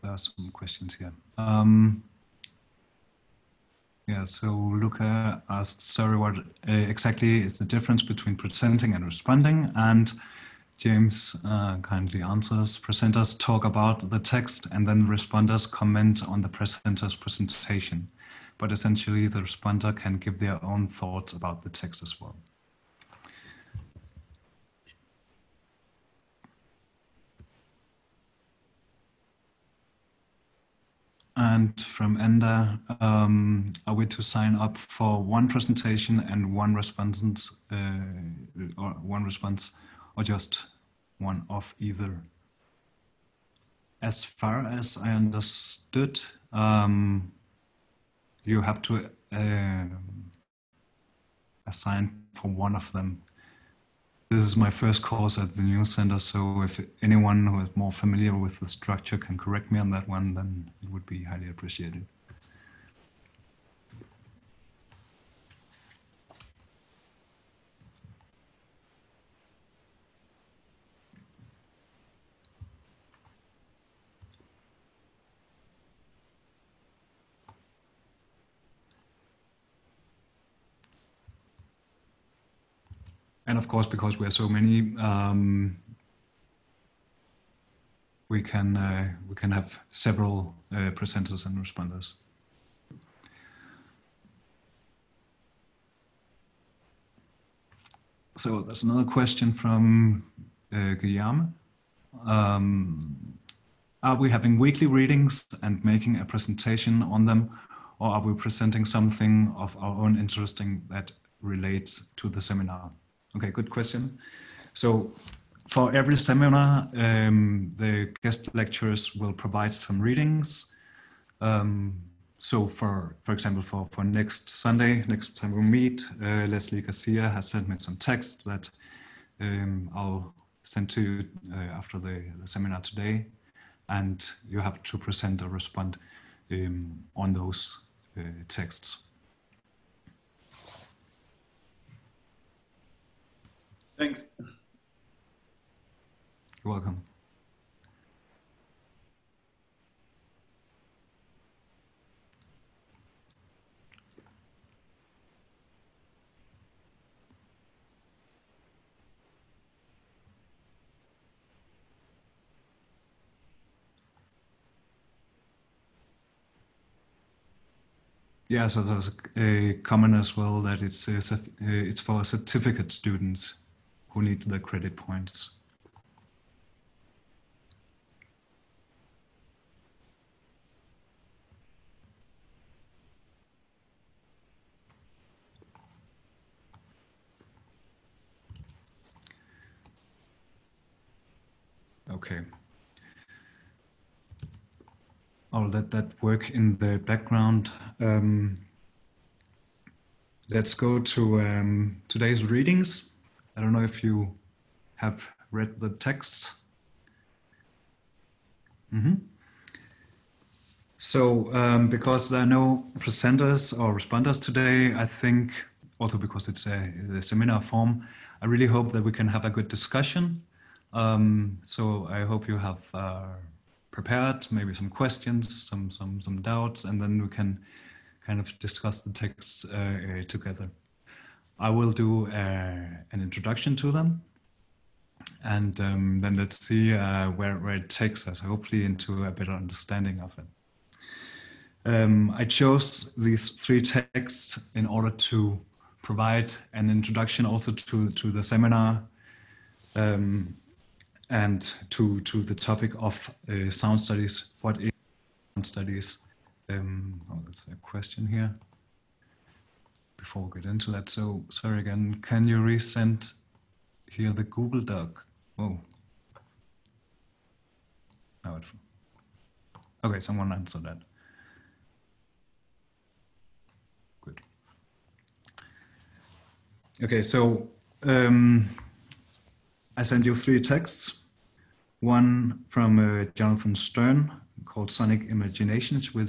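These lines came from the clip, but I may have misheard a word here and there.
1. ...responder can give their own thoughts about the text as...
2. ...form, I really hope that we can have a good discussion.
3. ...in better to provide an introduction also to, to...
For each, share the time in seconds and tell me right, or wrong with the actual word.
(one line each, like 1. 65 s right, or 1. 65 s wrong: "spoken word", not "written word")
1. 19 s right
2. 217 s right
3. 244 s wrong: "order", not "better".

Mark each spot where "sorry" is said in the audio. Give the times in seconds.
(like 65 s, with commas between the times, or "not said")
5 s, 261 s.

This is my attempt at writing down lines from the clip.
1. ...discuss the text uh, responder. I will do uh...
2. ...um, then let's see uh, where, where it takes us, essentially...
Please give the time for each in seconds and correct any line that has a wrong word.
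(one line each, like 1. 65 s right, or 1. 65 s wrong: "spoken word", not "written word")
1. 228 s wrong: "together", not "responder"
2. 235 s wrong: "hopefully", not "essentially".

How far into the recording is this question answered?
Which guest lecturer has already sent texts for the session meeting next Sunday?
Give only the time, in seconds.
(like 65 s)
126 s.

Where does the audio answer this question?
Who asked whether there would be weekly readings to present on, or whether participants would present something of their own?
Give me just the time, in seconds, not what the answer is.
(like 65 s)
100 s.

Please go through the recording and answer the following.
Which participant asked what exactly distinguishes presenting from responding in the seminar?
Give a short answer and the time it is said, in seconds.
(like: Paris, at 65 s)
Luca, at 4 s.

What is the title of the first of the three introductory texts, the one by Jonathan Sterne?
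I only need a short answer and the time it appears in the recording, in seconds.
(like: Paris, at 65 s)
Sonic Imaginations, at 284 s.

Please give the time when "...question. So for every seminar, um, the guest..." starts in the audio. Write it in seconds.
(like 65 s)
113 s.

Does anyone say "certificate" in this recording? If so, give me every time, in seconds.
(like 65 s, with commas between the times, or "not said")
172 s.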